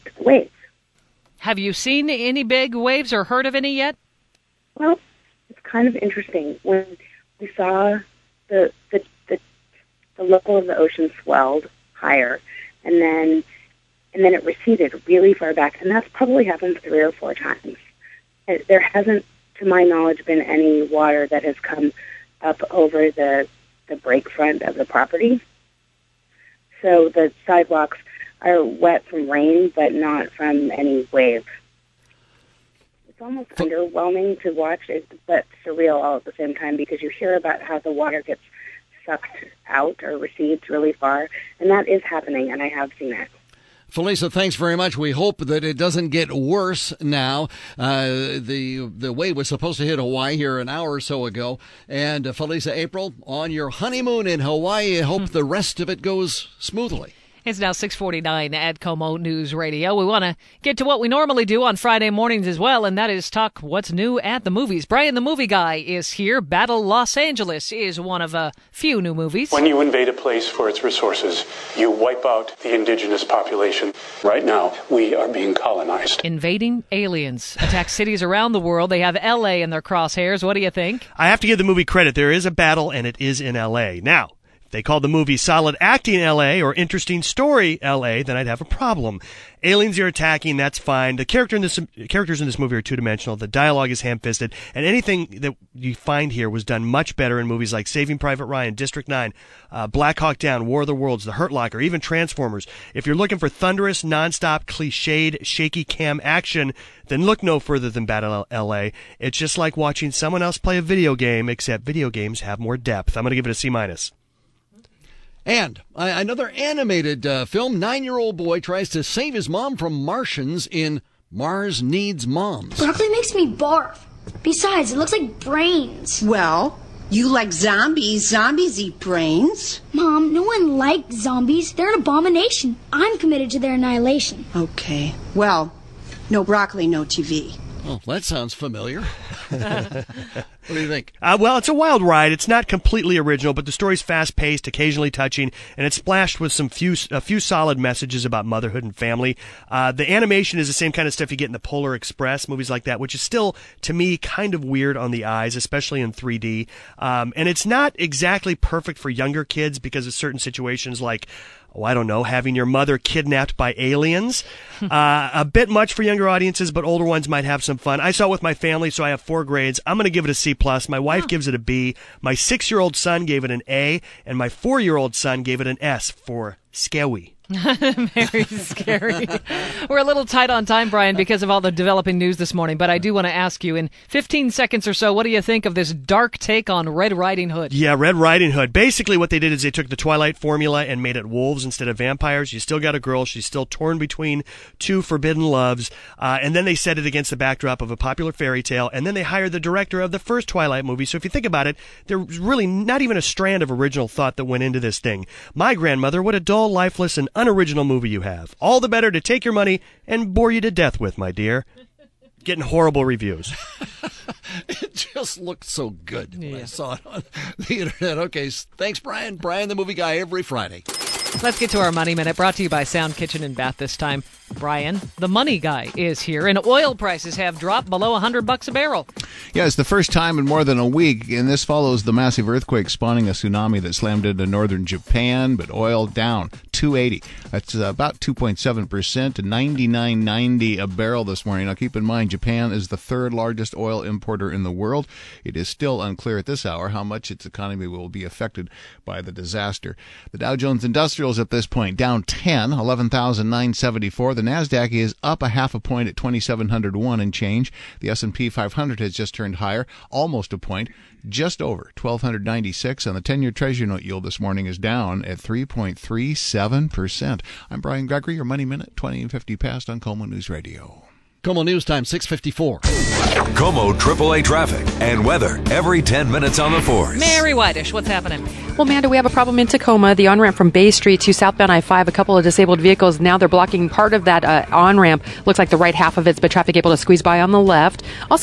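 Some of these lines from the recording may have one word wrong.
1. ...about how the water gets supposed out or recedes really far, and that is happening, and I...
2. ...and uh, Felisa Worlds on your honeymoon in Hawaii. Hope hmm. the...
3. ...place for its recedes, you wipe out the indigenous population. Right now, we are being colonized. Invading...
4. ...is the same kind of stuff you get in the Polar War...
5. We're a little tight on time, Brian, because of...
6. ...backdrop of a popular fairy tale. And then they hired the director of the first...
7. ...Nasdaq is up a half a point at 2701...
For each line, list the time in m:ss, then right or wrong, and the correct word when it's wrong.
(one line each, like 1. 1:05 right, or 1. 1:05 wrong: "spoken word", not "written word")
1. 0:37 wrong: "sucked", not "supposed"
2. 0:51 wrong: "April", not "Worlds"
3. 1:10 wrong: "resources", not "recedes"
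4. 2:30 wrong: "Express", not "War"
5. 2:59 right
6. 3:17 right
7. 4:14 right.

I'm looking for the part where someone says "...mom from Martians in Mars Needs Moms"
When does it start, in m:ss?
1:59.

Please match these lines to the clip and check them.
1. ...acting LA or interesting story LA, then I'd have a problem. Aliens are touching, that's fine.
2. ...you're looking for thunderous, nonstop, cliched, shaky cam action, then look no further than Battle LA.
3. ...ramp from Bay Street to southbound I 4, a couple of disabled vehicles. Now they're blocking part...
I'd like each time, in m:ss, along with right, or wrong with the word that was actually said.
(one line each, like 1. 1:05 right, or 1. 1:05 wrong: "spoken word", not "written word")
1. 1:25 wrong: "attacking", not "touching"
2. 1:43 right
3. 4:40 wrong: "5", not "4".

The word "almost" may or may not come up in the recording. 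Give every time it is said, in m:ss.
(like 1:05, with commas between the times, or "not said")
0:33, 4:20.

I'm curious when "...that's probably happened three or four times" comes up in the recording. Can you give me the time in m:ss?
0:15.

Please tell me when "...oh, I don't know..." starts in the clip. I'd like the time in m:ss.
2:41.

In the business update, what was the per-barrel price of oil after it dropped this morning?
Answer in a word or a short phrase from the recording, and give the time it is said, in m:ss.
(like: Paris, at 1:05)
$99.90, at 3:59.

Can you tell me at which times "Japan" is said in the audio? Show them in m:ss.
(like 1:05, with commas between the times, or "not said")
3:54, 4:02.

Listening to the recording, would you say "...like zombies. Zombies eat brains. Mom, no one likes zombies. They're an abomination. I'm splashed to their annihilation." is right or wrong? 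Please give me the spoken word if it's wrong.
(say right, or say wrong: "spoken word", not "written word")
wrong: "committed", not "splashed".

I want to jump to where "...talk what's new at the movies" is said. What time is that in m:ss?
1:03.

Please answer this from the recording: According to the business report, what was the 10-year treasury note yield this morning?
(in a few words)
3.37%.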